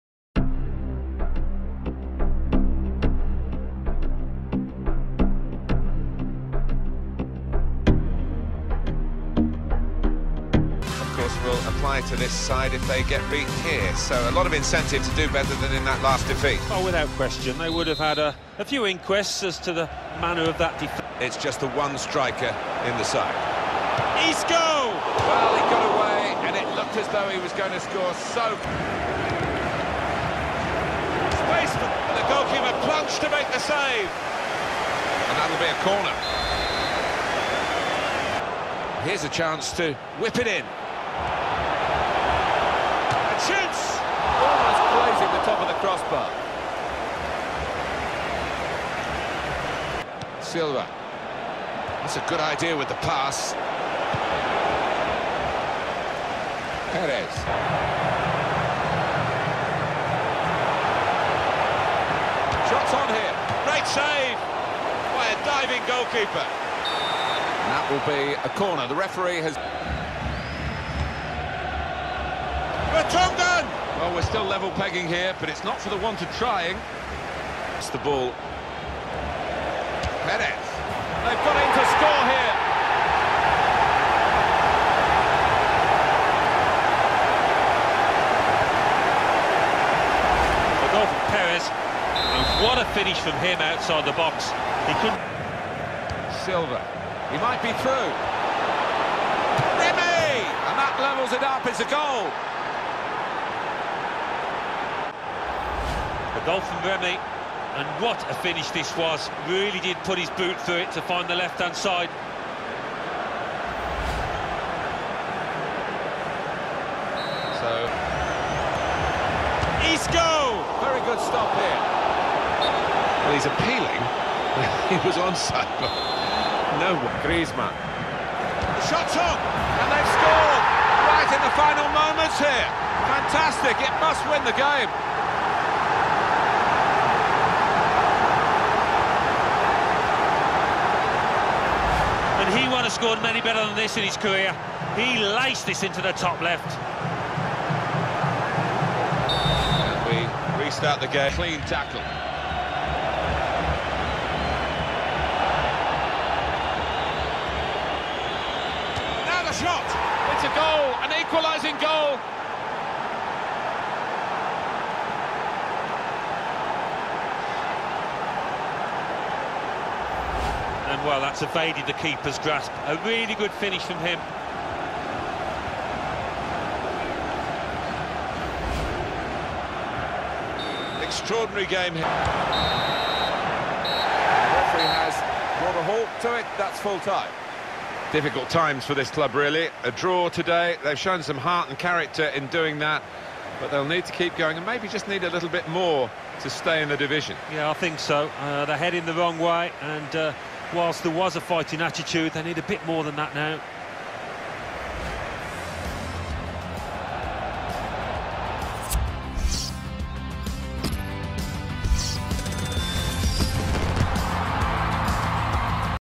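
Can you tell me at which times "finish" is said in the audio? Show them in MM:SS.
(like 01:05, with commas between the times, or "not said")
01:32, 01:48, 02:53.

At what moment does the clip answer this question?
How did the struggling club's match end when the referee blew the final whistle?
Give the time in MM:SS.
03:09.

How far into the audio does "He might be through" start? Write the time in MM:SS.
01:37.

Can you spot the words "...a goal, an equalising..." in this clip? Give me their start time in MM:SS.
02:40.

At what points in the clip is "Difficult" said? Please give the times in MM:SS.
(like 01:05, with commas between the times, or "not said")
03:08.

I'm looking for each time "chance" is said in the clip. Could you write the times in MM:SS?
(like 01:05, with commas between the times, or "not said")
00:39, 00:43.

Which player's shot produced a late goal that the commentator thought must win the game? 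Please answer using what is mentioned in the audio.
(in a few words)
Griezmann.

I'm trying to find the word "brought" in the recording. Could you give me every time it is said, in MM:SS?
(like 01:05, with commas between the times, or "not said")
03:05.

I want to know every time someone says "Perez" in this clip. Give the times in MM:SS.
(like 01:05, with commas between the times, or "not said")
00:56, 01:20, 01:31.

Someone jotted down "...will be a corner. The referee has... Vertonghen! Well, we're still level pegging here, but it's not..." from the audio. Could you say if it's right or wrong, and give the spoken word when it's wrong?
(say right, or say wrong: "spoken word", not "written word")
right.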